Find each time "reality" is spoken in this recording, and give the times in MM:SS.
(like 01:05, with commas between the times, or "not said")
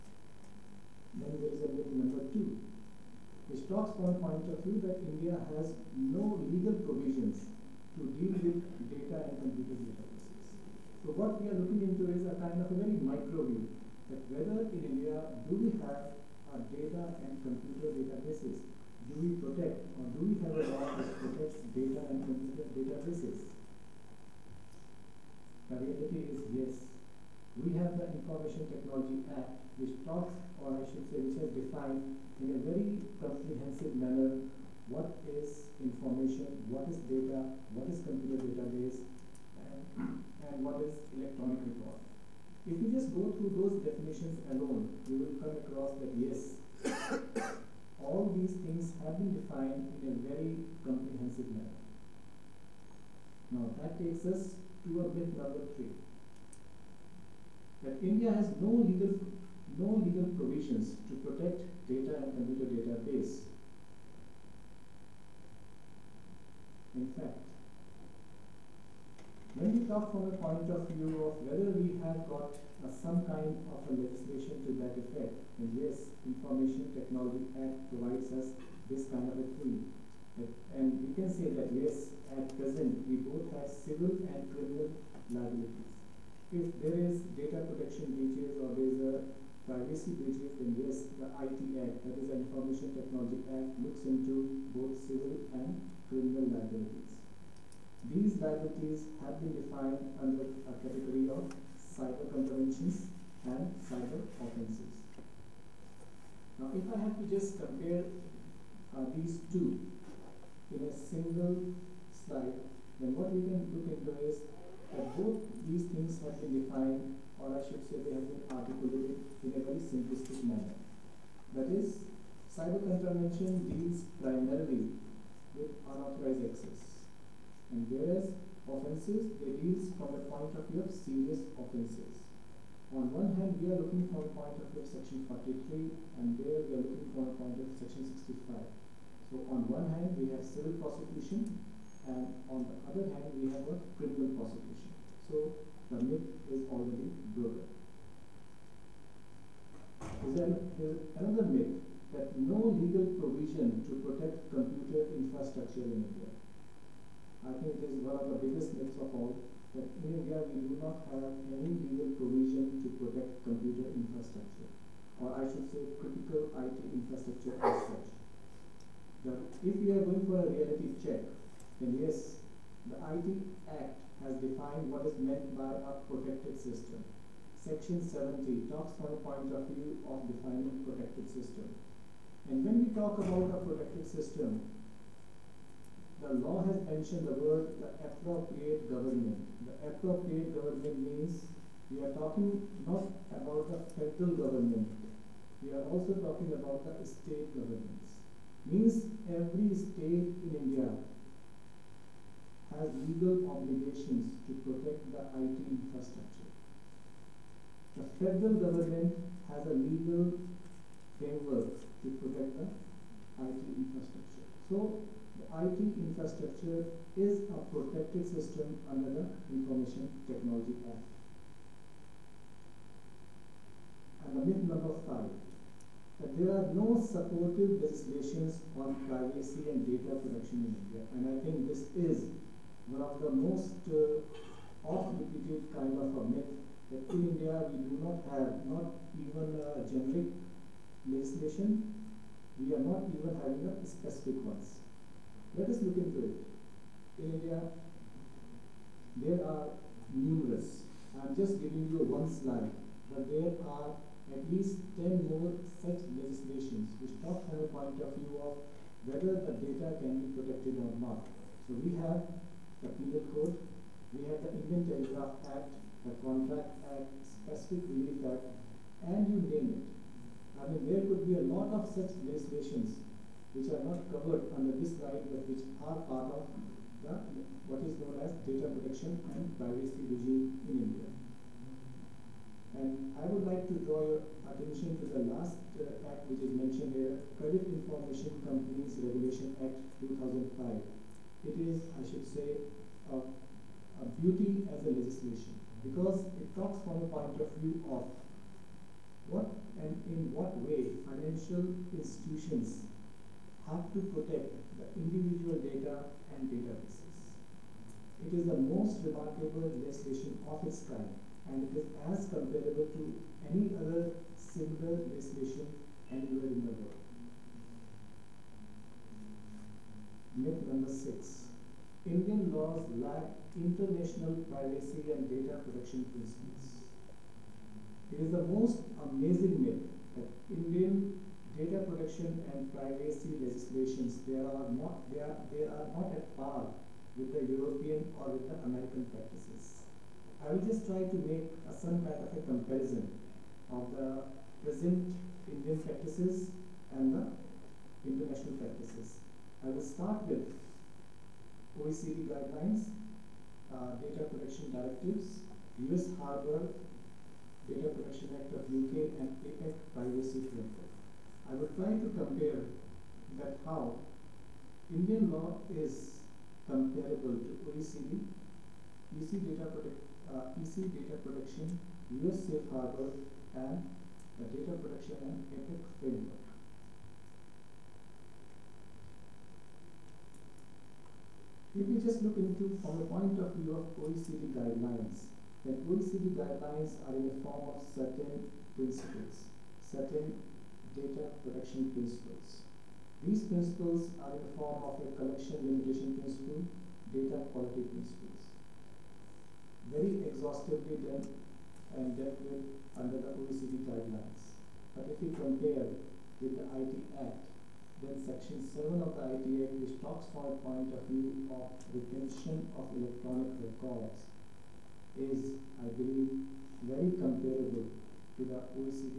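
00:25, 02:50.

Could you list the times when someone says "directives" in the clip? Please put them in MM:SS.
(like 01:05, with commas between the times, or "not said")
05:54.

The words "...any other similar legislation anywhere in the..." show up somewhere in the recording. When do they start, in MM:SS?
05:13.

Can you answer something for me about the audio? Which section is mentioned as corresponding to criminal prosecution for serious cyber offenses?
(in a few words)
Section 65.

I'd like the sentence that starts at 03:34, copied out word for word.
So the IT infrastructure is a protected system under the Information Technology Act.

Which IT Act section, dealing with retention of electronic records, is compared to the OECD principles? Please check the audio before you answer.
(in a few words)
Section 7.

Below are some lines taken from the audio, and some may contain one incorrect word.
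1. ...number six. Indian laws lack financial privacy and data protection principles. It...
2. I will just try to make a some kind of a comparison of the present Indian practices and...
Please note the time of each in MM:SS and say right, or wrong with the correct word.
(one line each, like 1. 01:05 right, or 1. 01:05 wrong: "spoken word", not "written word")
1. 05:20 wrong: "international", not "financial"
2. 05:40 right.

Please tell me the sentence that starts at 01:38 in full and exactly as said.
These liabilities have been defined under a category of cyber contraventions and cyber offenses.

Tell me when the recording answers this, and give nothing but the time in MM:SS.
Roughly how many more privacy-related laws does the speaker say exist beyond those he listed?
04:14.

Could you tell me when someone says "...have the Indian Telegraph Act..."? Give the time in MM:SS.
04:24.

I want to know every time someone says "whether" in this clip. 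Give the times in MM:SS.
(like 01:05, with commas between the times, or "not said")
00:14, 01:11, 04:19.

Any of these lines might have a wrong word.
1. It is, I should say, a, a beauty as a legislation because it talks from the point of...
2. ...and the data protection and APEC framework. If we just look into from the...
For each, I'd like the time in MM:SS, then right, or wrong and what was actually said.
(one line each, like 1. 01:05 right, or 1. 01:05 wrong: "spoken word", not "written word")
1. 04:51 right
2. 06:13 right.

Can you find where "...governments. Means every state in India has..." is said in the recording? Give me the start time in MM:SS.
03:17.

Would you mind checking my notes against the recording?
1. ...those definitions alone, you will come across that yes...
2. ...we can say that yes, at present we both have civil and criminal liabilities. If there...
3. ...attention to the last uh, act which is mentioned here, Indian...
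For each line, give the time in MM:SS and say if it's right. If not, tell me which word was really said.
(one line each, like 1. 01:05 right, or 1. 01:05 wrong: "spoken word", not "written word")
1. 00:43 right
2. 01:21 right
3. 04:44 wrong: "Credit", not "Indian".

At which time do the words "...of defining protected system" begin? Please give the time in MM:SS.
03:00.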